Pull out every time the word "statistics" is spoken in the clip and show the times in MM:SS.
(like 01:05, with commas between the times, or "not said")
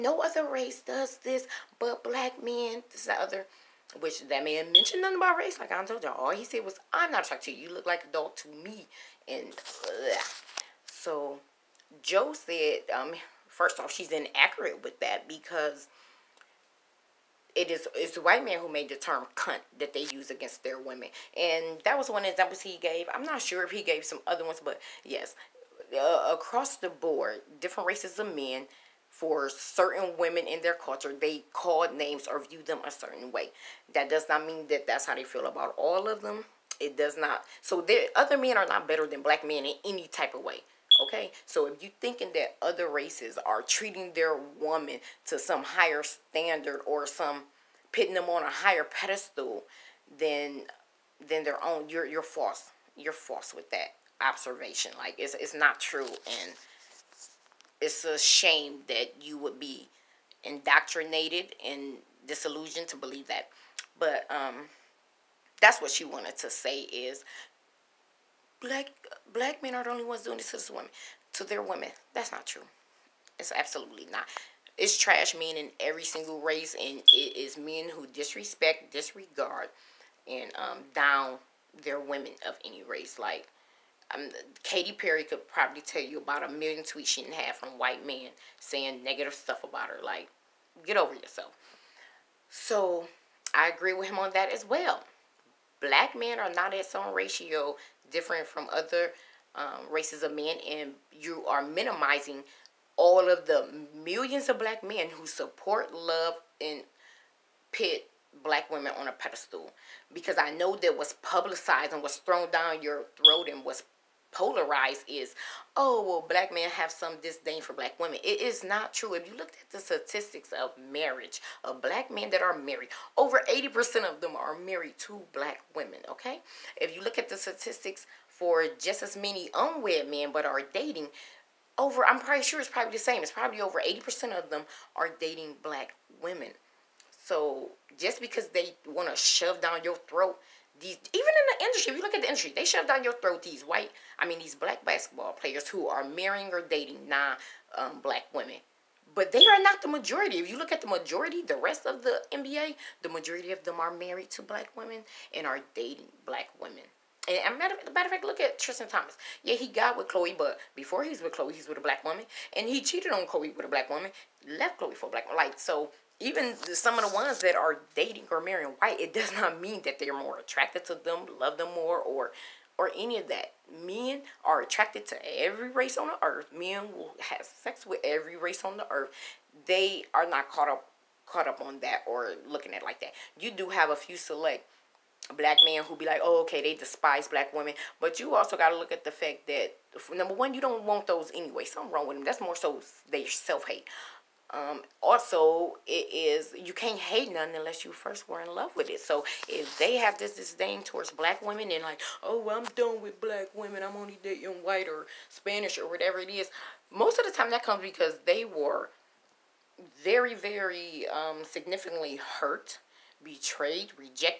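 01:59, 02:07.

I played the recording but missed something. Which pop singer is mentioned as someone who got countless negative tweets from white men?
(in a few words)
Katy Perry.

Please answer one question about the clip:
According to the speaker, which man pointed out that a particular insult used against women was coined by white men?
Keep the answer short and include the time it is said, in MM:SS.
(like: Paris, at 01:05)
Joe, at 00:12.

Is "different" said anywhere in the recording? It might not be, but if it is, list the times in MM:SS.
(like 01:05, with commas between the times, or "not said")
00:27, 01:38.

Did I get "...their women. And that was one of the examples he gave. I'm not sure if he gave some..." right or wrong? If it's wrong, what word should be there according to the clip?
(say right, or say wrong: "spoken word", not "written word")
right.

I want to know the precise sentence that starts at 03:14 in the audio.
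Um, also, it is you can't hate none unless you first were in love with it.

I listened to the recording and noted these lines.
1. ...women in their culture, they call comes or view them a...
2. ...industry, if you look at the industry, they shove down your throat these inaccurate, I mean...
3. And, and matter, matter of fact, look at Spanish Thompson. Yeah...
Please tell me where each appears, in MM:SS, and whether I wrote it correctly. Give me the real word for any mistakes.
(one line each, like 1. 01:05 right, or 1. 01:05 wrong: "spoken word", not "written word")
1. 00:30 wrong: "names", not "comes"
2. 02:21 wrong: "white", not "inaccurate"
3. 02:37 wrong: "Tristan", not "Spanish".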